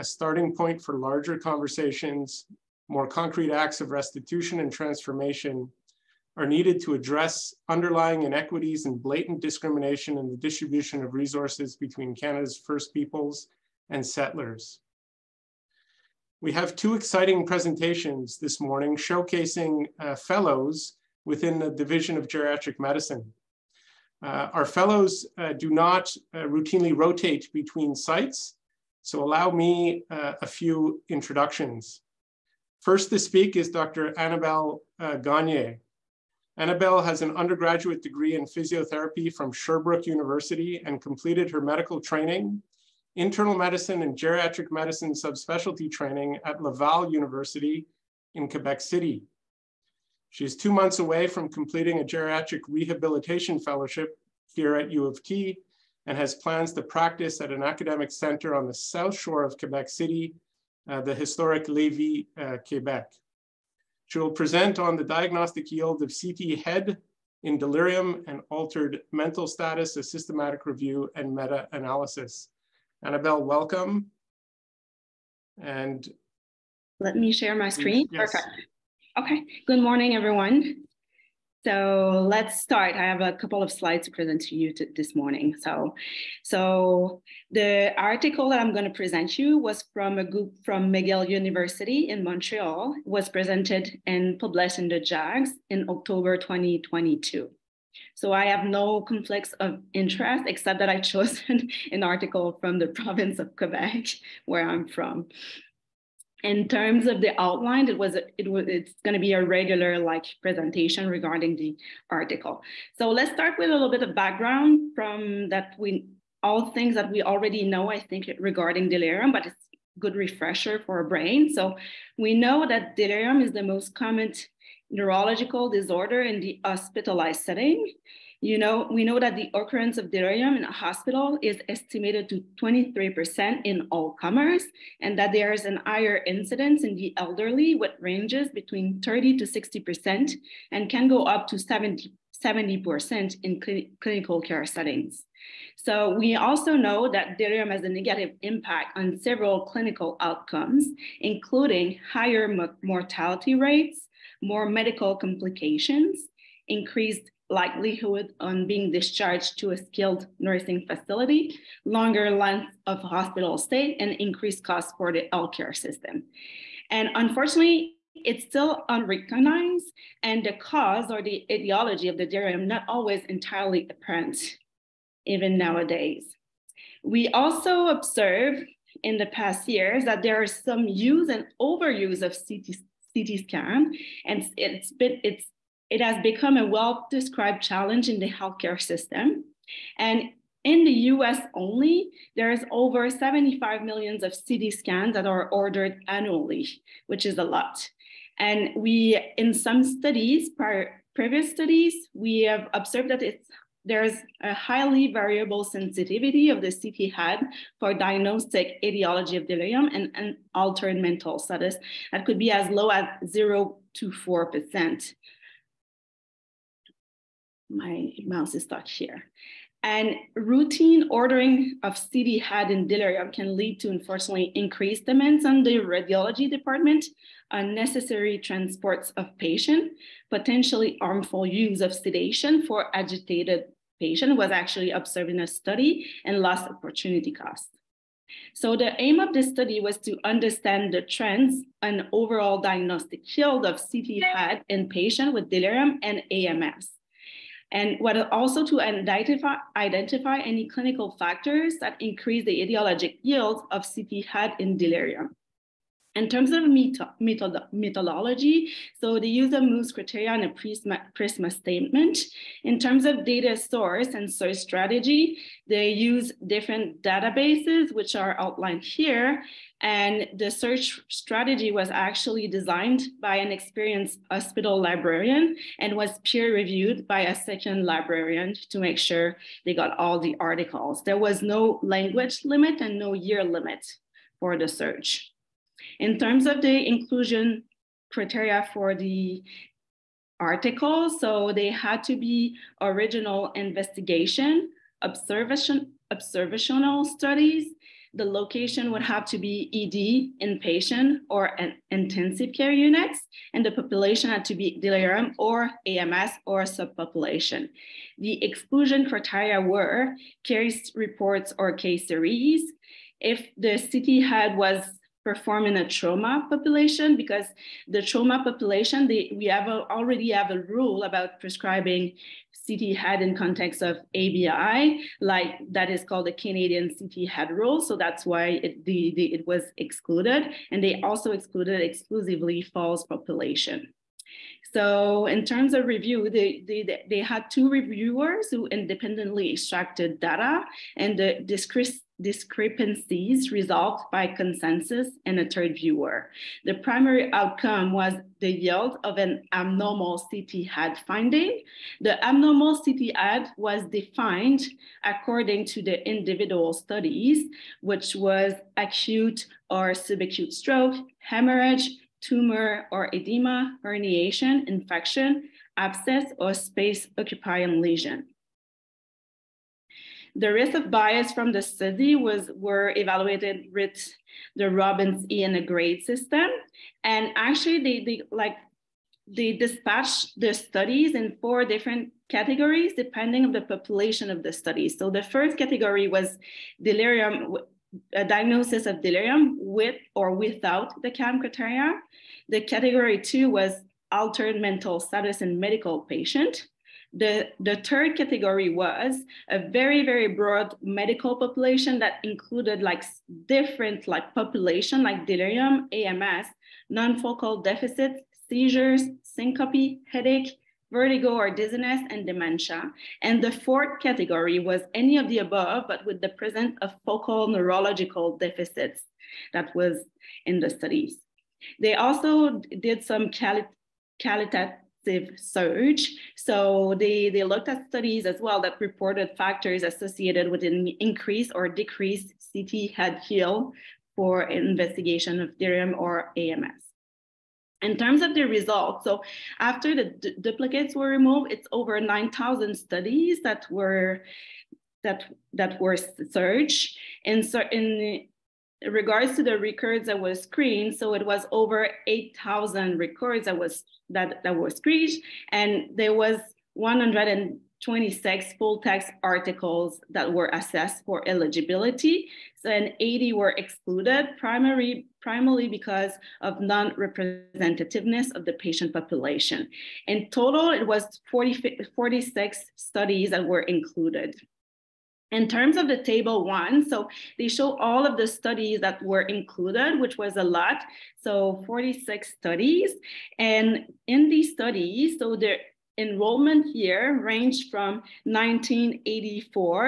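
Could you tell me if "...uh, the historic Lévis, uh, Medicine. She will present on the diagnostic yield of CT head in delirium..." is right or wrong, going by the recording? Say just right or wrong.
wrong.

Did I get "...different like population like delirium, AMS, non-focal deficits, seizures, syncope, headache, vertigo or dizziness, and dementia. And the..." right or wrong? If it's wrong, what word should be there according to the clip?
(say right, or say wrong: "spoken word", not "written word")
right.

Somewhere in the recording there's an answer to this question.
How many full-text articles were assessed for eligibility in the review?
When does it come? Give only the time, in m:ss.
7:36.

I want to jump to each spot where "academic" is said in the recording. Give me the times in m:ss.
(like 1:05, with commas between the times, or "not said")
0:57.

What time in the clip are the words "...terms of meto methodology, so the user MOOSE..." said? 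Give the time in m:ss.
4:16.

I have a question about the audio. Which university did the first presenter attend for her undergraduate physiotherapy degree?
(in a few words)
Sherbrooke University.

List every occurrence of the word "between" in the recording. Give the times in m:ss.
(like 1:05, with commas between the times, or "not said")
0:11, 0:27, 2:18.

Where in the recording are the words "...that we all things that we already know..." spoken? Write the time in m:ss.
1:55.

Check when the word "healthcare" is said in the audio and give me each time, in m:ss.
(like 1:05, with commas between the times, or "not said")
2:45, 3:08.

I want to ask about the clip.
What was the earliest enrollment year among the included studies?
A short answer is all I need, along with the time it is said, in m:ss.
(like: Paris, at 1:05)
1984, at 8:08.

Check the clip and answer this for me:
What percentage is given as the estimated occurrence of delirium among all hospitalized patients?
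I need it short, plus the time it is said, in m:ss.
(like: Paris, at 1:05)
23%, at 2:12.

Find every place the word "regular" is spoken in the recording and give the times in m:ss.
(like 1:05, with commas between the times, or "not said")
1:49.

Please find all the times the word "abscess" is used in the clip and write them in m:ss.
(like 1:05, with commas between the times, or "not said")
6:05.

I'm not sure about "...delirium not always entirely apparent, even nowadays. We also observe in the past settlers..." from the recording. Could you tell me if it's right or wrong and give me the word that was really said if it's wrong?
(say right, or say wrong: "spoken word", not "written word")
wrong: "years", not "settlers".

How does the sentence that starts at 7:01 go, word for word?
They also did some quali qualitative search.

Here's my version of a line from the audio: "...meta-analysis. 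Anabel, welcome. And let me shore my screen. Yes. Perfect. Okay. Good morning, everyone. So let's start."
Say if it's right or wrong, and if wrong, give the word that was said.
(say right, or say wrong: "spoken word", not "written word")
wrong: "share", not "shore".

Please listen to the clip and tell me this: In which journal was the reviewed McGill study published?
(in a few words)
JAGS.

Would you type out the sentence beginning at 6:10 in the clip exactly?
The risk of bias from the study was were evaluated with the Robbins E and grade system.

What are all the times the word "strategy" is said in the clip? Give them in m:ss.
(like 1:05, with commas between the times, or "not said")
4:24, 4:31.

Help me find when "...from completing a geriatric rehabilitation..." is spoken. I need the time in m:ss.
0:51.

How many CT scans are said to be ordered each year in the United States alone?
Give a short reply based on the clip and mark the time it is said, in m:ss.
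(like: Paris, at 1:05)
Over 75 million, at 3:12.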